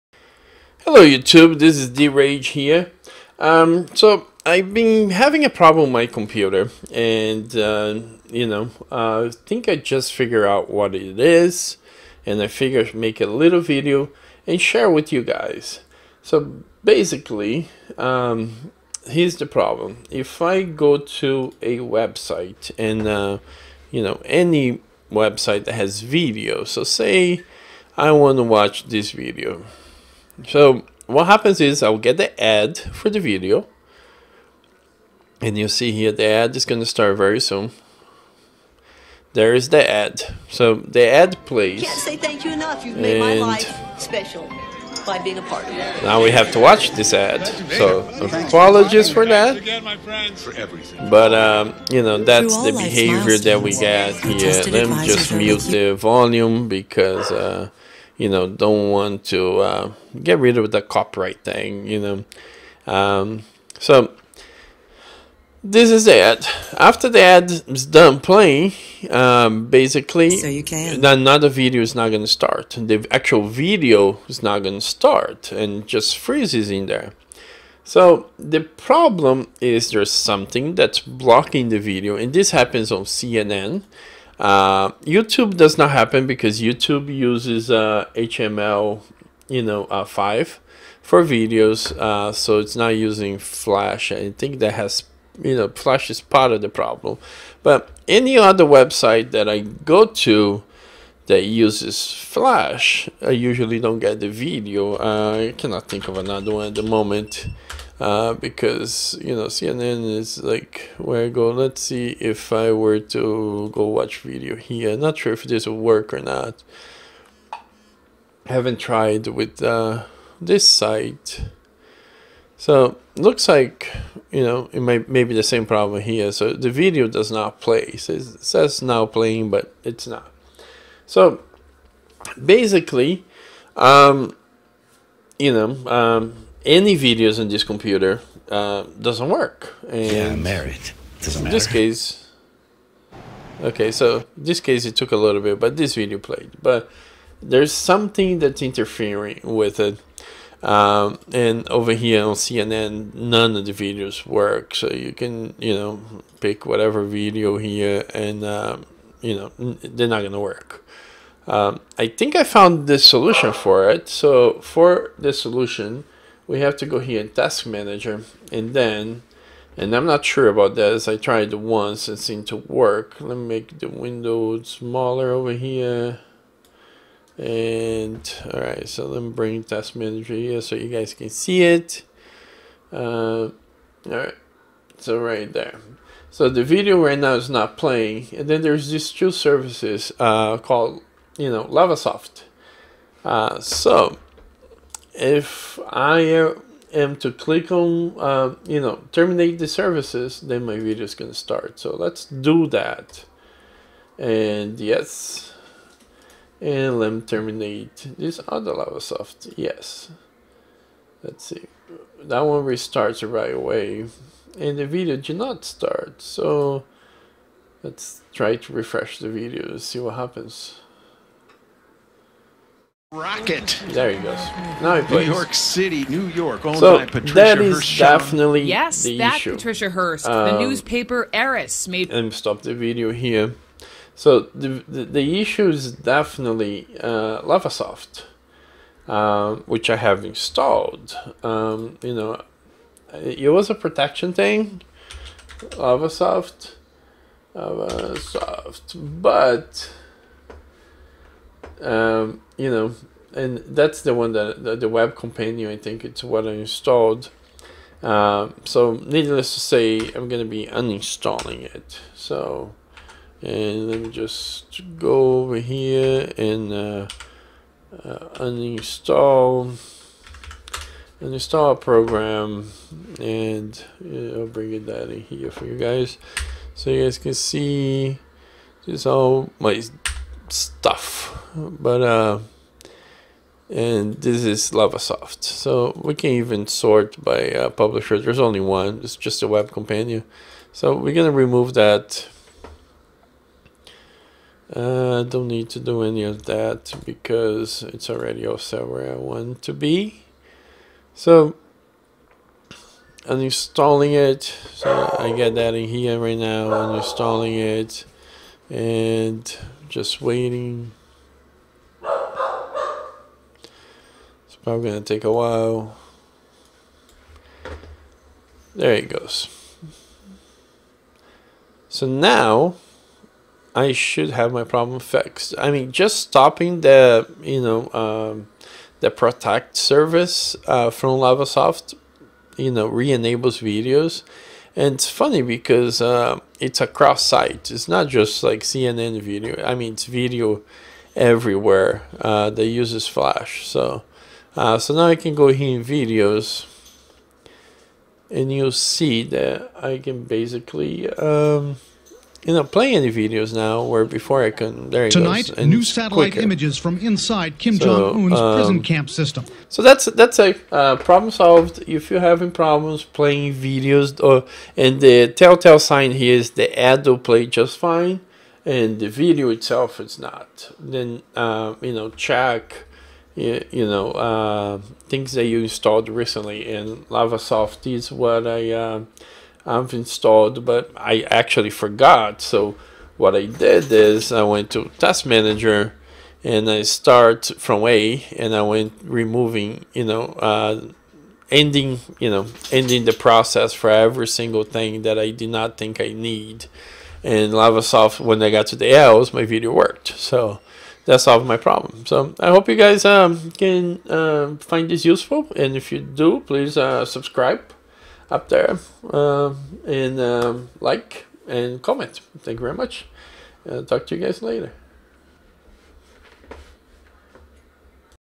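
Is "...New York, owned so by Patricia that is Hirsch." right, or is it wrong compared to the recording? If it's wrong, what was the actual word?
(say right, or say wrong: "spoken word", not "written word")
right.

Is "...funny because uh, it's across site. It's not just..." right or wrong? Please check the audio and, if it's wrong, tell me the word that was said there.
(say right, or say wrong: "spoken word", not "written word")
right.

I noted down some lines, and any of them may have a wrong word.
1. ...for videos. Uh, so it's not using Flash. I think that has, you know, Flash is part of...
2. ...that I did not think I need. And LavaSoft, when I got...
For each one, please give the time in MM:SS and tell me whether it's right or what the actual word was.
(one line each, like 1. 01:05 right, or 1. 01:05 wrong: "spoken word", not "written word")
1. 01:31 right
2. 06:35 right.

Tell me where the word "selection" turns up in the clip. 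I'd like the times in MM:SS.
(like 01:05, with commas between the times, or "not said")
not said.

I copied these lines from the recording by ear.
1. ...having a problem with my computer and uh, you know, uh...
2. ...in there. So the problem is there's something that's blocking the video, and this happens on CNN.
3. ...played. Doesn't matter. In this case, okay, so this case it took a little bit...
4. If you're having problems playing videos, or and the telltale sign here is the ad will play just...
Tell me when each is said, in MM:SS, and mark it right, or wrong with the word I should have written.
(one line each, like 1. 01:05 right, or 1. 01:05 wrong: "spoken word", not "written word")
1. 00:05 right
2. 01:16 right
3. 02:20 wrong: "married", not "played"
4. 06:01 right.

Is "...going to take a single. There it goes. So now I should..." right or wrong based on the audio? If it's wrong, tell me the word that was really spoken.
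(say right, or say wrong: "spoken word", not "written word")
wrong: "while", not "single".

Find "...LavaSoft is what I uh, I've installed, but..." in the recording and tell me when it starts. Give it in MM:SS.
06:17.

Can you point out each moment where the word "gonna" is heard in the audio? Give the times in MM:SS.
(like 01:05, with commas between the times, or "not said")
02:40, 04:51.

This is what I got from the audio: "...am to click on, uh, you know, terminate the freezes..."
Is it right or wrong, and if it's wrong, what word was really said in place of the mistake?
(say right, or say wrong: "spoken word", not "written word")
wrong: "services", not "freezes".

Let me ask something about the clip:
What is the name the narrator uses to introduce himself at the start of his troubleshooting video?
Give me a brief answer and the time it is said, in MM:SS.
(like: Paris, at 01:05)
DeRage, at 00:01.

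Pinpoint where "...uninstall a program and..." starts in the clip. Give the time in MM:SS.
04:31.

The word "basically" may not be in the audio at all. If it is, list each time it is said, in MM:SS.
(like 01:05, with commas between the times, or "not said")
00:16, 01:09, 02:12, 05:50.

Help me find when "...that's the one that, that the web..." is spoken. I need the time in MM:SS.
04:13.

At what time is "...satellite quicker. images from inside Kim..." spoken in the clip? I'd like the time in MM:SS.
05:55.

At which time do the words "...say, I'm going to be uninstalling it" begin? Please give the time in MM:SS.
04:19.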